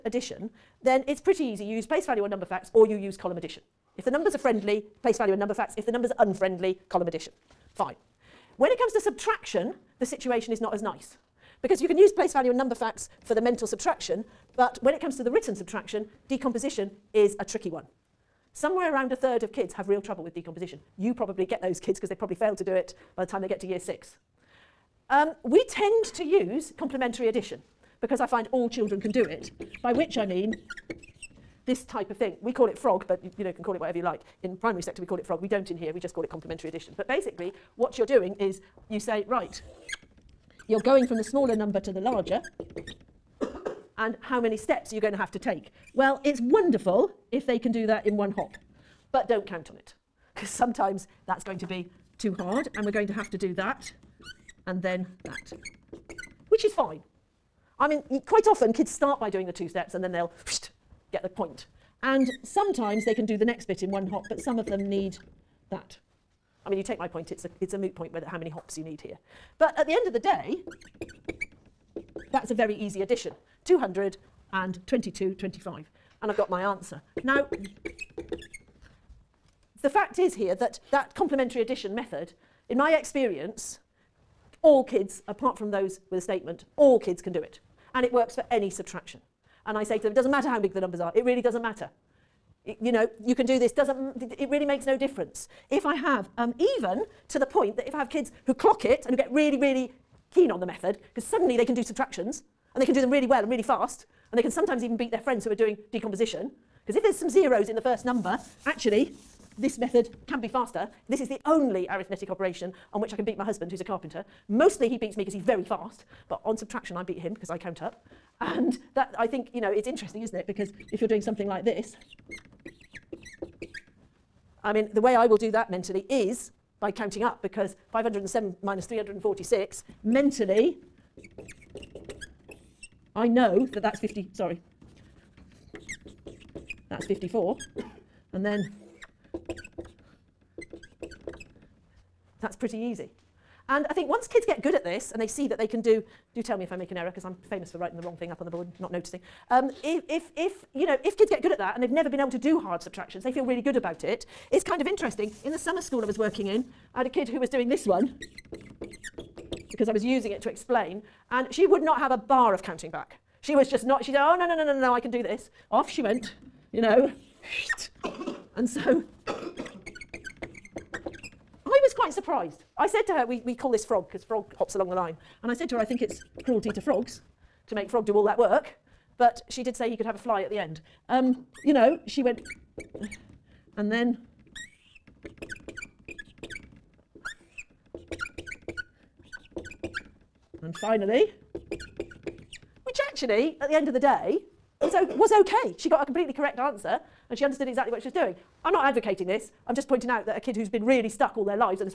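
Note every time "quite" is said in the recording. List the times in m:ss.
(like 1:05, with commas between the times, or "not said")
0:58, 2:51.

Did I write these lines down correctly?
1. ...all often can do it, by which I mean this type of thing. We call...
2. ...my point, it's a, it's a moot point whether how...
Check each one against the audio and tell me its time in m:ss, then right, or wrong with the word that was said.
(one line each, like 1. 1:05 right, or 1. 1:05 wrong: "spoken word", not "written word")
1. 0:28 wrong: "children", not "often"
2. 1:06 right.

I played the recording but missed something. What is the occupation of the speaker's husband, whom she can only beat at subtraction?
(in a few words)
carpenter.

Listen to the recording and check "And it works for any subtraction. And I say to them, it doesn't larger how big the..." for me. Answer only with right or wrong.
wrong.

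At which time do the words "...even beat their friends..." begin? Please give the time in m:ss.
1:44.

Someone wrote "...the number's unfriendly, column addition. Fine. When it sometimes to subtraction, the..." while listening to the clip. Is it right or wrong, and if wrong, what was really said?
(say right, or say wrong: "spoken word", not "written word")
wrong: "comes", not "sometimes".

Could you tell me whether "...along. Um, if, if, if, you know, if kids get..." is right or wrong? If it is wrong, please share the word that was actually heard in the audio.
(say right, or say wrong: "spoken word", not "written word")
wrong: "noticing", not "along".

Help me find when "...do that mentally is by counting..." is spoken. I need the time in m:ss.
2:05.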